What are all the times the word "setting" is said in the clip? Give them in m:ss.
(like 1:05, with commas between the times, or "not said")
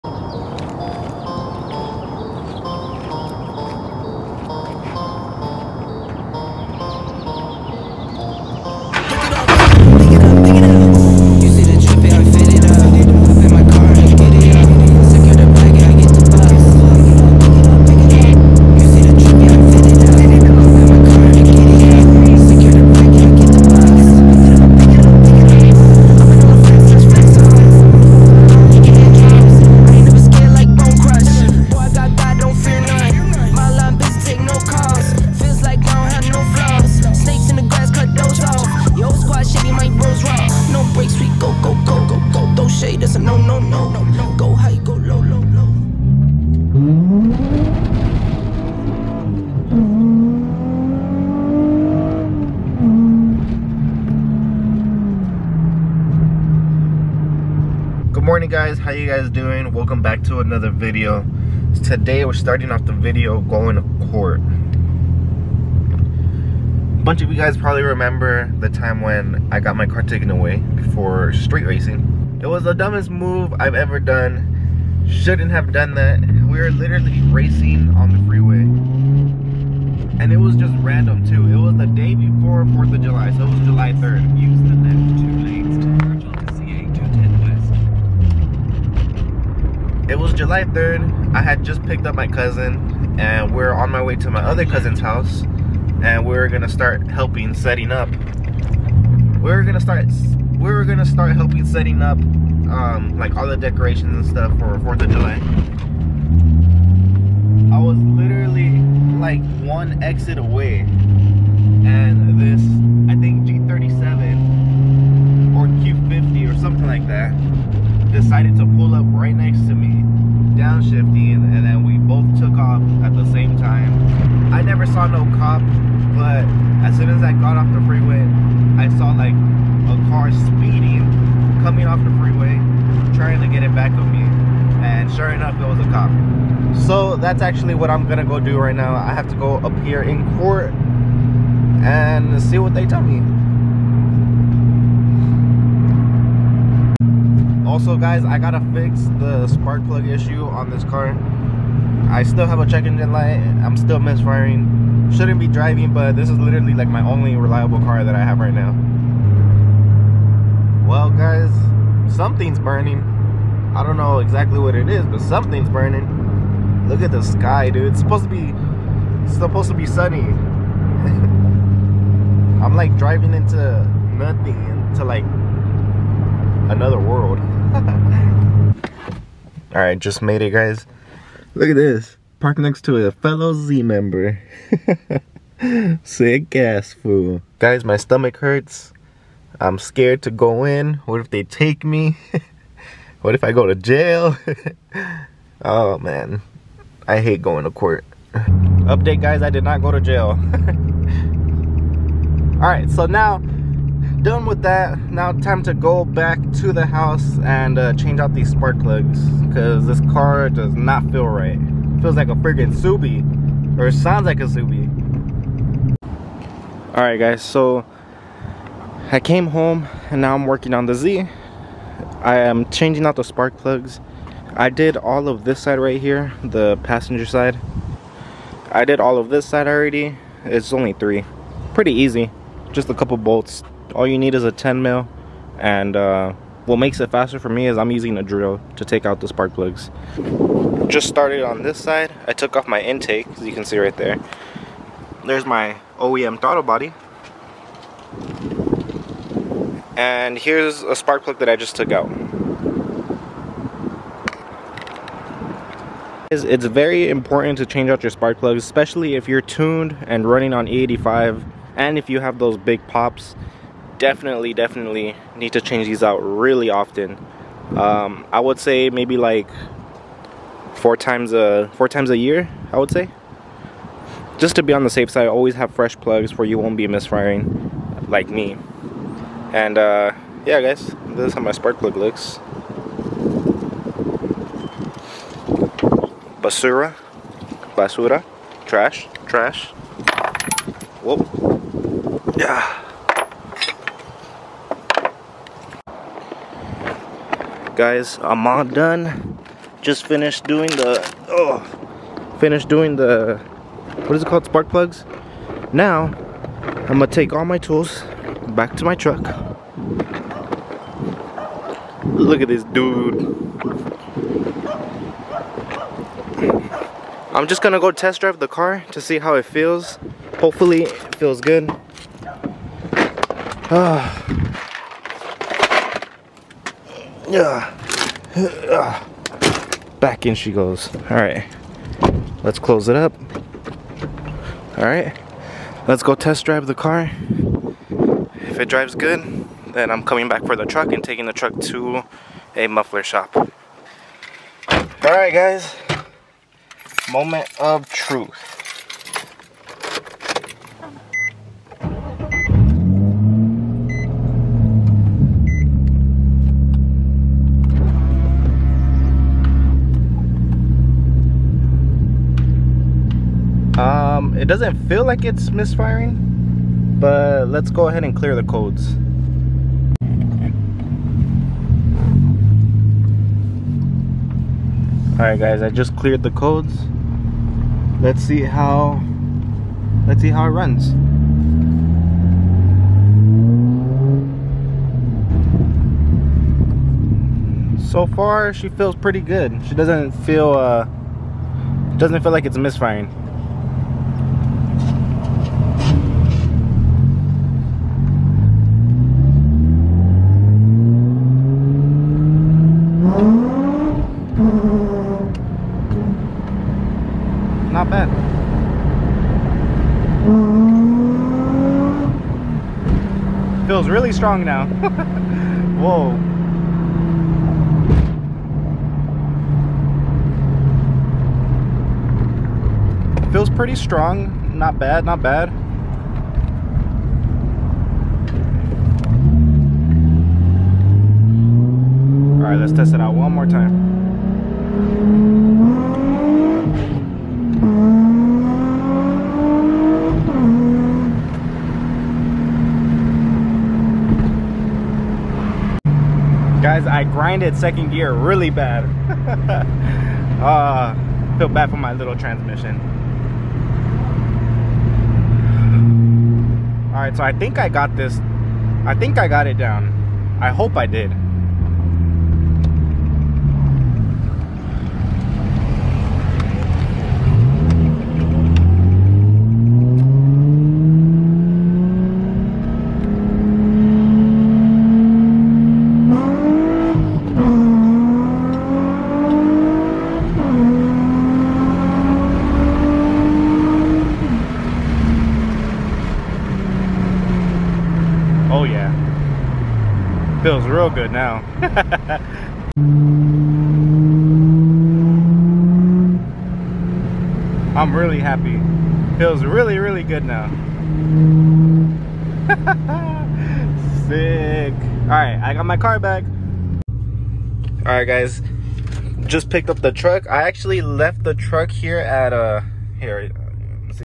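1:37, 1:41.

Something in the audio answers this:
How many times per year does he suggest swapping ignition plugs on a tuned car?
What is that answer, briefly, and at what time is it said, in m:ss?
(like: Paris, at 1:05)
4, at 4:31.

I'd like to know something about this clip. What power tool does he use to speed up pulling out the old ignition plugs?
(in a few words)
A drill.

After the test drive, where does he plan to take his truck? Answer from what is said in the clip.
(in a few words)
A muffler shop.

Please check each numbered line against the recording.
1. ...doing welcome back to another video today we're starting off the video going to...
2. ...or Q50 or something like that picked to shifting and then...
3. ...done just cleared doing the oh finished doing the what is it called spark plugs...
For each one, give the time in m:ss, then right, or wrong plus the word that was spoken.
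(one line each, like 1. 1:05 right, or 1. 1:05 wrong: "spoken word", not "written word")
1. 0:59 right
2. 1:55 wrong: "decided", not "picked"
3. 4:58 wrong: "finished", not "cleared".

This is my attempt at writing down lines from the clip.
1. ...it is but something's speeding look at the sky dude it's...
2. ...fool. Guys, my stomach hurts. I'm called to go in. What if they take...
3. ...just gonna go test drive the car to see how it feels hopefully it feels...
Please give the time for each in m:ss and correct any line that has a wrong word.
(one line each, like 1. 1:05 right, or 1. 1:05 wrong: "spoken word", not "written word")
1. 2:44 wrong: "burning", not "speeding"
2. 3:06 wrong: "scared", not "called"
3. 5:17 right.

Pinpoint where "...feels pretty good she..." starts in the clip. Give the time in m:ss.
6:28.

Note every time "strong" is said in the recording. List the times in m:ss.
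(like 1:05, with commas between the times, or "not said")
6:54, 7:03.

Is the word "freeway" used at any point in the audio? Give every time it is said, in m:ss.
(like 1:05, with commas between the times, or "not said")
1:18, 2:07, 2:12.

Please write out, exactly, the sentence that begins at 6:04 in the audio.
It doesn't feel like it's misfiring, but let's go ahead and clear the codes.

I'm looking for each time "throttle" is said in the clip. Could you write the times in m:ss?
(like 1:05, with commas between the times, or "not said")
4:06.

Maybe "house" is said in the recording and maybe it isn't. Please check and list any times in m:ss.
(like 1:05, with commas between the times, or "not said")
1:34, 3:26.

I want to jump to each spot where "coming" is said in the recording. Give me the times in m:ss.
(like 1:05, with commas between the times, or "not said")
2:11, 5:40.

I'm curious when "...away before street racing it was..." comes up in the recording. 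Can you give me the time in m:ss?
1:10.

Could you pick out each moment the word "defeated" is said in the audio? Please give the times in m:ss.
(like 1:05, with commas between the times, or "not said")
not said.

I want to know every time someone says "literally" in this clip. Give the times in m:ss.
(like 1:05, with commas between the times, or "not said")
1:16, 1:47, 2:36.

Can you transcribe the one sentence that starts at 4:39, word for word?
And uh, yeah, guys, this is how my spark plug looks.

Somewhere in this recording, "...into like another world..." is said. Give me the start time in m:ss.
2:54.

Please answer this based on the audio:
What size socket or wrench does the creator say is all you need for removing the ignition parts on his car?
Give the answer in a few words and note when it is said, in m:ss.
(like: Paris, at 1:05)
10 mil, at 3:54.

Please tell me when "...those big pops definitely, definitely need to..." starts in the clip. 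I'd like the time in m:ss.
4:22.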